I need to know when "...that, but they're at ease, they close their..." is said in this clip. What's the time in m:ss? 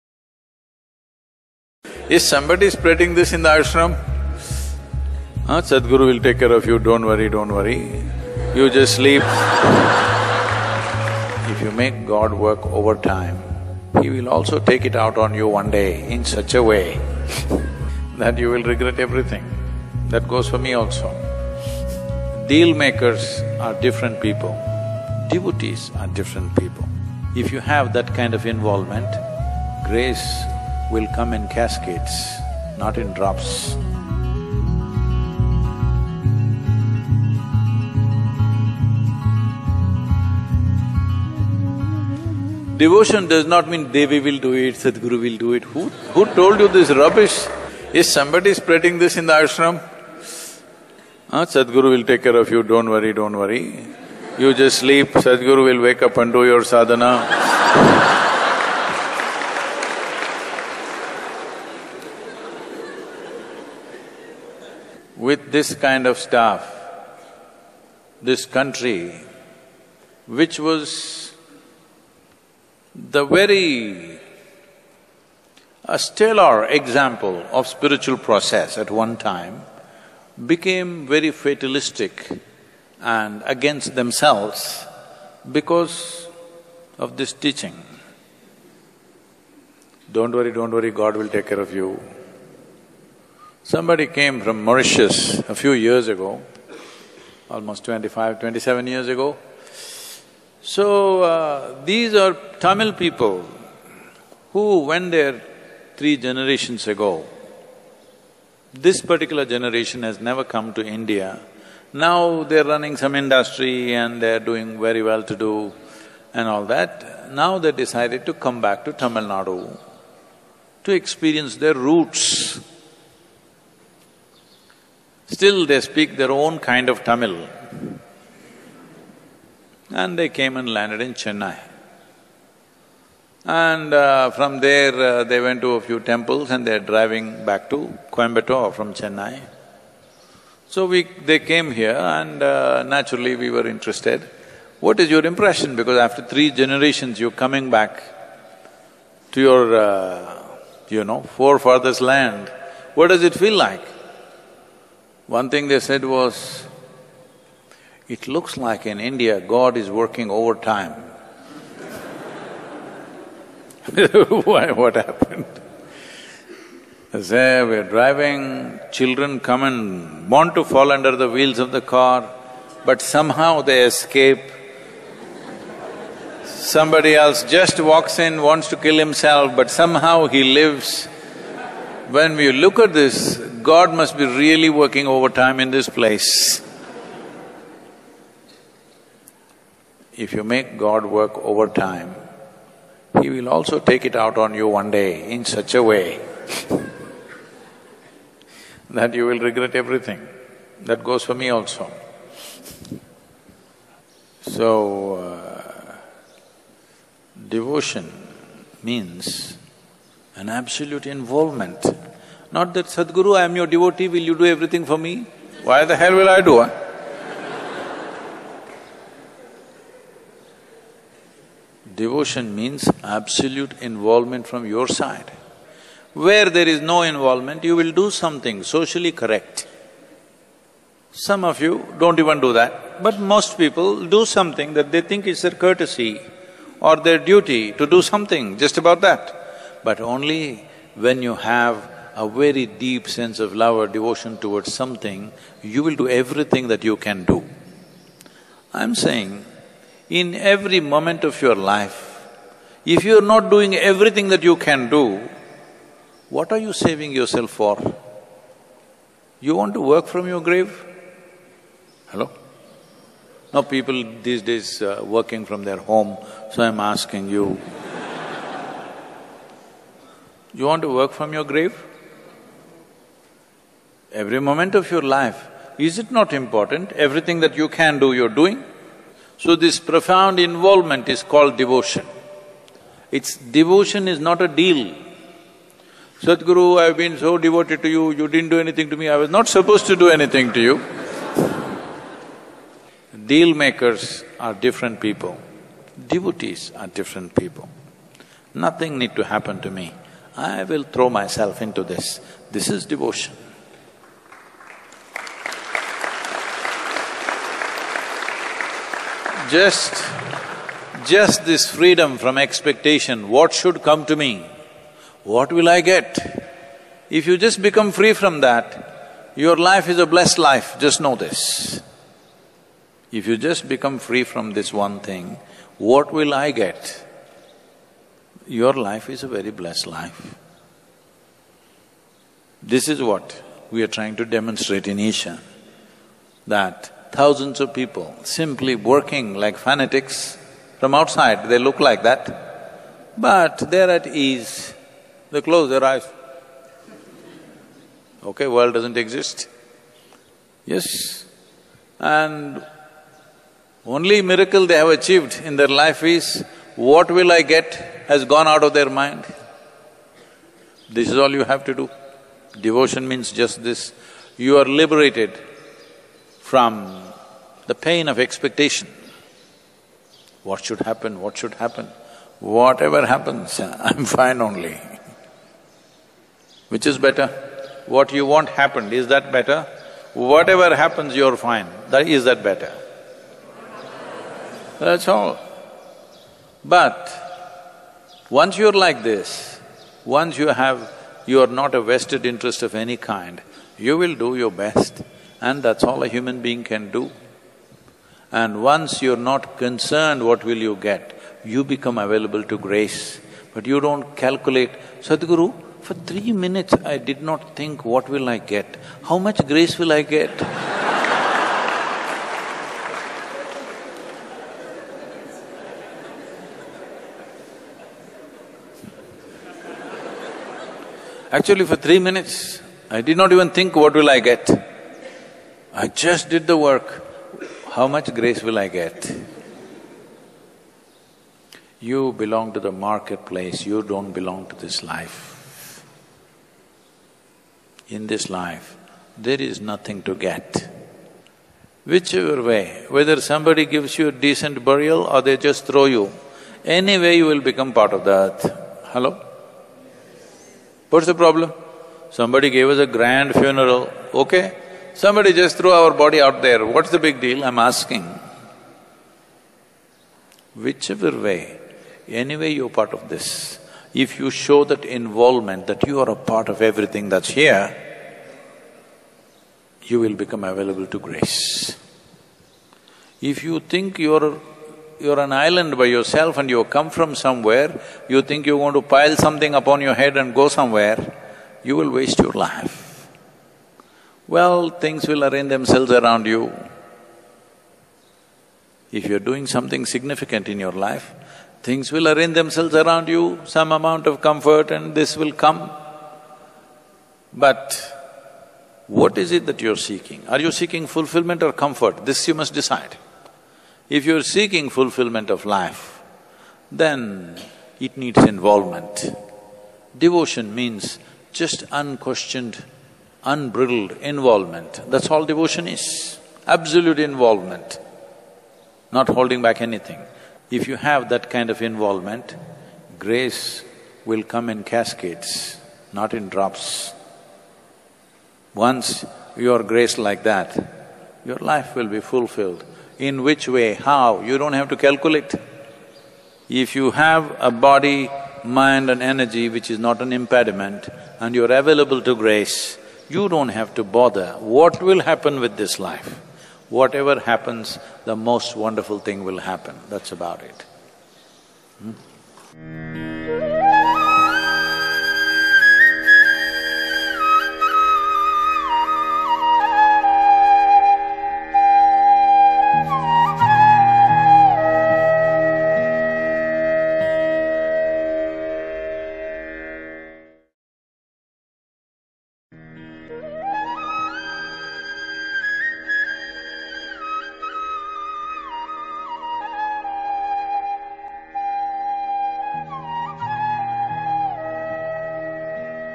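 5:42.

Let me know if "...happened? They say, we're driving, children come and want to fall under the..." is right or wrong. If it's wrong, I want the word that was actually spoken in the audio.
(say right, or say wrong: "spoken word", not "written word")
right.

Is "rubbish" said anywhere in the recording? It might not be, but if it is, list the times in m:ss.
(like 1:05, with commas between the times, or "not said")
0:46.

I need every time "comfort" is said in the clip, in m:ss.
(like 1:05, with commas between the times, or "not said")
8:14, 8:21.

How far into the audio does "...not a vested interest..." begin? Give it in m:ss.
6:31.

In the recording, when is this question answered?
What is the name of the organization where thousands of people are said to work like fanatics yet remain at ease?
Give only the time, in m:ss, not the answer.
5:34.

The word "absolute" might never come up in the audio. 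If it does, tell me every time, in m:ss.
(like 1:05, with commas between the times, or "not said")
3:30, 3:43, 8:36.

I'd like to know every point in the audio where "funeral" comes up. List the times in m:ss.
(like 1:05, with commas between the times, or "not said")
7:33.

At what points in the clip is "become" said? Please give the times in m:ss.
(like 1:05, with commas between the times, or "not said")
5:17, 5:23, 6:41, 7:27, 7:50.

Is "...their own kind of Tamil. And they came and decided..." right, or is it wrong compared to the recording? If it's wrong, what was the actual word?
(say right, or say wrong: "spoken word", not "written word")
wrong: "landed", not "decided".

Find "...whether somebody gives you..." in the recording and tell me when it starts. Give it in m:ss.
7:22.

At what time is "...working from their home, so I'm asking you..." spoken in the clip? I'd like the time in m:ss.
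4:25.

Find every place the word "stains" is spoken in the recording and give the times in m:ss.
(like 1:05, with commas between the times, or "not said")
not said.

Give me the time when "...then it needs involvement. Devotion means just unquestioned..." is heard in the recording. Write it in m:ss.
8:26.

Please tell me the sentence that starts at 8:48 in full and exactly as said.
Once you are graced like that, your life will be fulfilled.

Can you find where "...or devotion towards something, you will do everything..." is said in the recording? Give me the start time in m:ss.
4:03.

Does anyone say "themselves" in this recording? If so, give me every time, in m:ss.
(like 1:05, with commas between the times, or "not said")
1:23, 8:05, 8:12.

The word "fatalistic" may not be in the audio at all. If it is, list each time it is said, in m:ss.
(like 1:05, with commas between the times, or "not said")
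1:21.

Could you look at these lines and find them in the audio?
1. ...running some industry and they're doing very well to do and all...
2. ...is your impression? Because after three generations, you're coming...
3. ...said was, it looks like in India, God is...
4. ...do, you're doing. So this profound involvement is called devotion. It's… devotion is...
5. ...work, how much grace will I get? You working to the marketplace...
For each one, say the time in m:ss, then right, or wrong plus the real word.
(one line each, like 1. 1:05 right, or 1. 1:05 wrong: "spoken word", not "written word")
1. 1:52 right
2. 2:24 right
3. 2:35 right
4. 4:37 right
5. 7:06 wrong: "belong", not "working".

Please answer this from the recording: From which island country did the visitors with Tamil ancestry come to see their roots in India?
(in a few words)
Mauritius.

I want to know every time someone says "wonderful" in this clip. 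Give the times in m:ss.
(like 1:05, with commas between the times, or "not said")
9:08.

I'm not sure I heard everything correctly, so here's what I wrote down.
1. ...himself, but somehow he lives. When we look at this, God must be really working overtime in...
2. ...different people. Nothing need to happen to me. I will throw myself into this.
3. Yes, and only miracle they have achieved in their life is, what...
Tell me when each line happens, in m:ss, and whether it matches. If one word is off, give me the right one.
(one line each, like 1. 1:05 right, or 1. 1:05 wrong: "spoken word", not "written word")
1. 2:58 right
2. 4:56 right
3. 5:50 right.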